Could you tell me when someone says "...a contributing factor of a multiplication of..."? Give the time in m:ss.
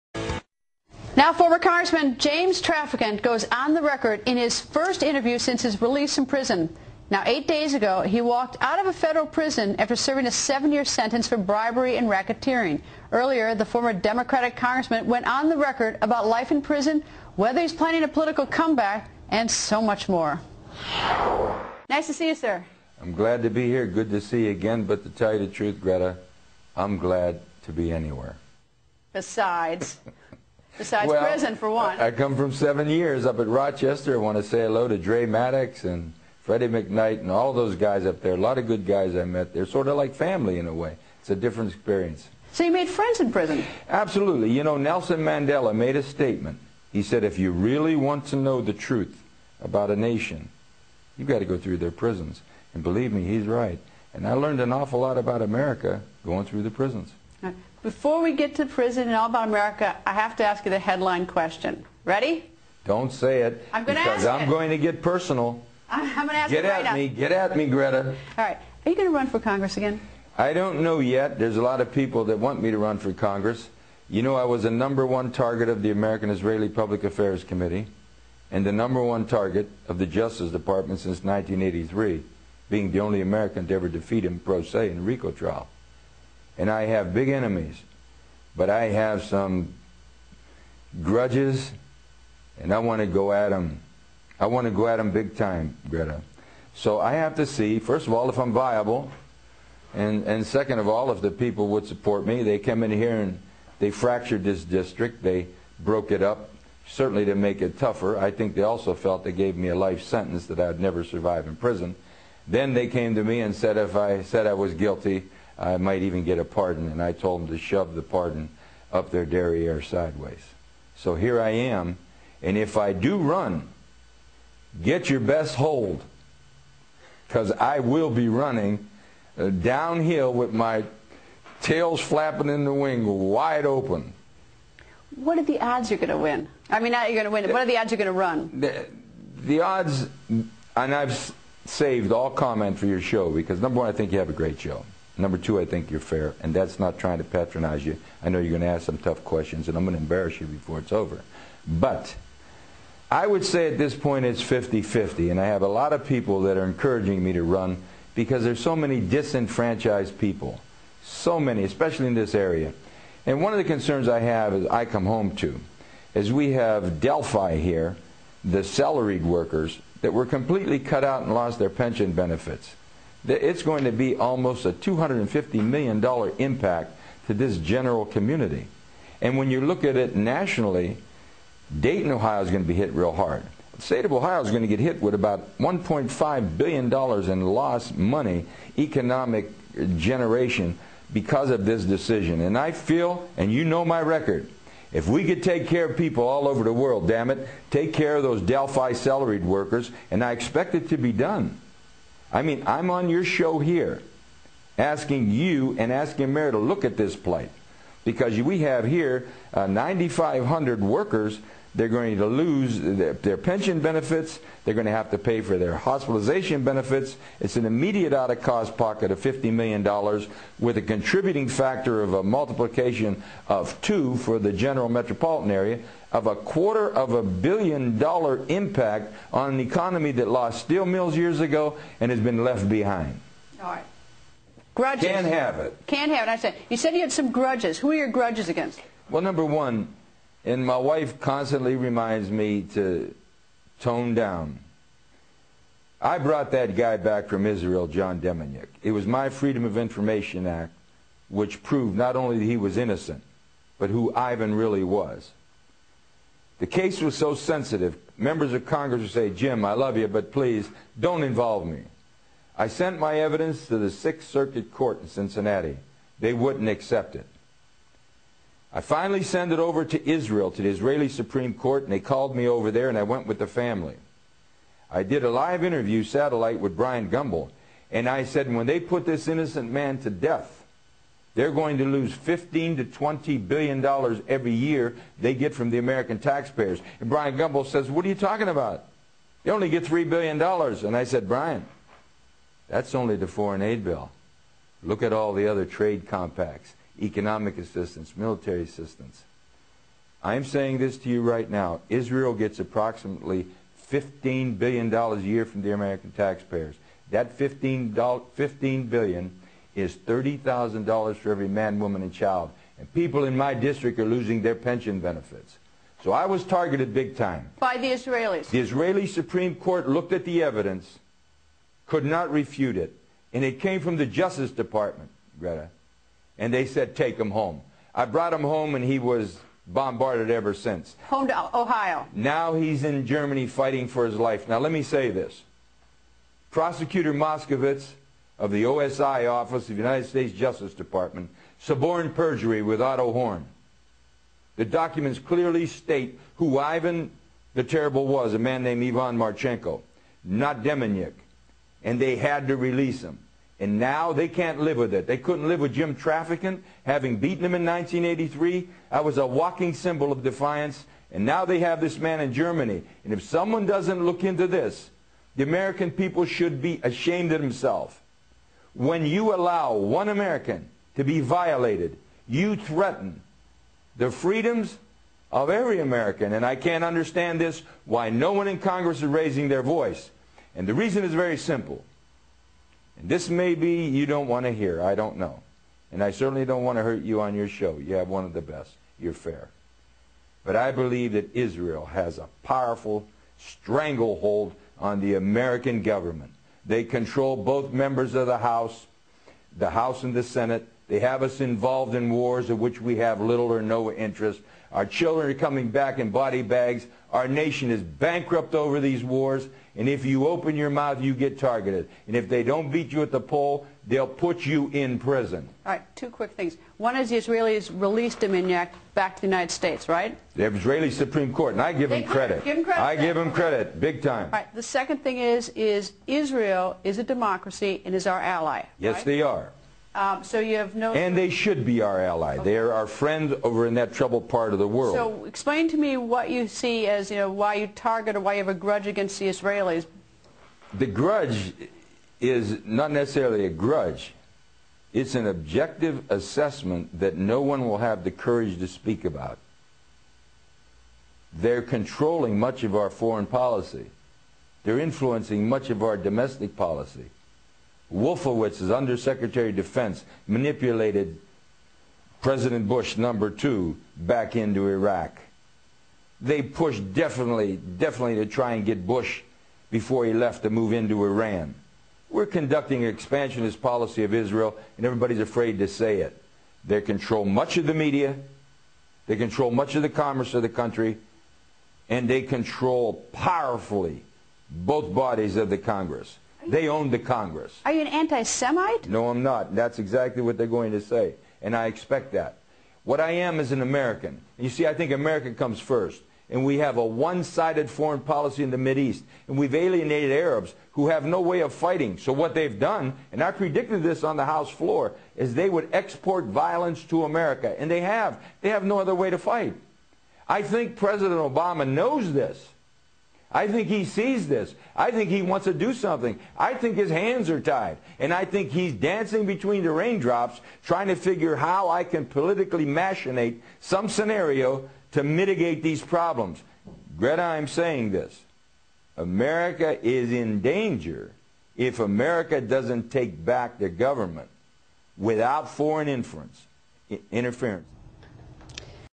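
3:40.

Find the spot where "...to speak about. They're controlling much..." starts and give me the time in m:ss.
7:28.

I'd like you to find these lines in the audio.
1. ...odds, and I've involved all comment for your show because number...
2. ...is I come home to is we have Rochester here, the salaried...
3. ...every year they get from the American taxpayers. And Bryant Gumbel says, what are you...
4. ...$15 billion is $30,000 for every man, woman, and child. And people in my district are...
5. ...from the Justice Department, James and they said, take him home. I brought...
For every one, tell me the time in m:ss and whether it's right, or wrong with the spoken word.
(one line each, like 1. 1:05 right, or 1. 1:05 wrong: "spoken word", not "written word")
1. 2:19 wrong: "saved", not "involved"
2. 2:44 wrong: "Delphi", not "Rochester"
3. 4:44 right
4. 5:07 right
5. 5:23 wrong: "Greta", not "James".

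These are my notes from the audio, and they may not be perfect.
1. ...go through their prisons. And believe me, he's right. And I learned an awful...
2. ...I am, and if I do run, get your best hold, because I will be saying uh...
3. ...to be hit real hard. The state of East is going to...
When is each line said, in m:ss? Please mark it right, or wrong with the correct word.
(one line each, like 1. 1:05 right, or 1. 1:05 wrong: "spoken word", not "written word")
1. 0:51 right
2. 2:01 wrong: "running", not "saying"
3. 3:02 wrong: "Ohio", not "East".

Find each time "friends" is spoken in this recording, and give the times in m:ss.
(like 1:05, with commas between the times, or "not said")
0:42, 7:12.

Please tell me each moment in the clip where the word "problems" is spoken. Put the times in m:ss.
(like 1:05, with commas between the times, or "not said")
8:45.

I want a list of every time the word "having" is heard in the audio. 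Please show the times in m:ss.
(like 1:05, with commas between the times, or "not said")
5:56.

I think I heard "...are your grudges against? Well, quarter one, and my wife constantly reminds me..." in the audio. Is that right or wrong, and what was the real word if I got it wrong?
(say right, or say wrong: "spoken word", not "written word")
wrong: "number", not "quarter".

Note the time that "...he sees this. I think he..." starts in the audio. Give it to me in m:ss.
8:33.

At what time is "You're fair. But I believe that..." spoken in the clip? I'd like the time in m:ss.
6:28.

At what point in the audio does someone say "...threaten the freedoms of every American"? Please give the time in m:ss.
6:12.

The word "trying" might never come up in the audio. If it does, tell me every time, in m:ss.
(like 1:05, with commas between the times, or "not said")
2:26, 8:40.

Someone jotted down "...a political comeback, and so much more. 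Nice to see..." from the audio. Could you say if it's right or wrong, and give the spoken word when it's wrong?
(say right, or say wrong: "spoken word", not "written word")
right.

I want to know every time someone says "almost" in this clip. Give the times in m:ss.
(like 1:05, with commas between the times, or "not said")
2:54.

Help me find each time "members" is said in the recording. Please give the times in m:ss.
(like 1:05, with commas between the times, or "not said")
4:18, 6:37.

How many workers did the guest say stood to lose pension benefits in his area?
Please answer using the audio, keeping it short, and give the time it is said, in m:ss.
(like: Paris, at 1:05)
9,500, at 3:29.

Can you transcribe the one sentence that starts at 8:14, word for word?
You see, I think America comes first.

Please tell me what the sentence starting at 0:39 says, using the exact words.
They're sort of like family in a way.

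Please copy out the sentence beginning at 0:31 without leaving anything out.
I come from seven years up at Rochester.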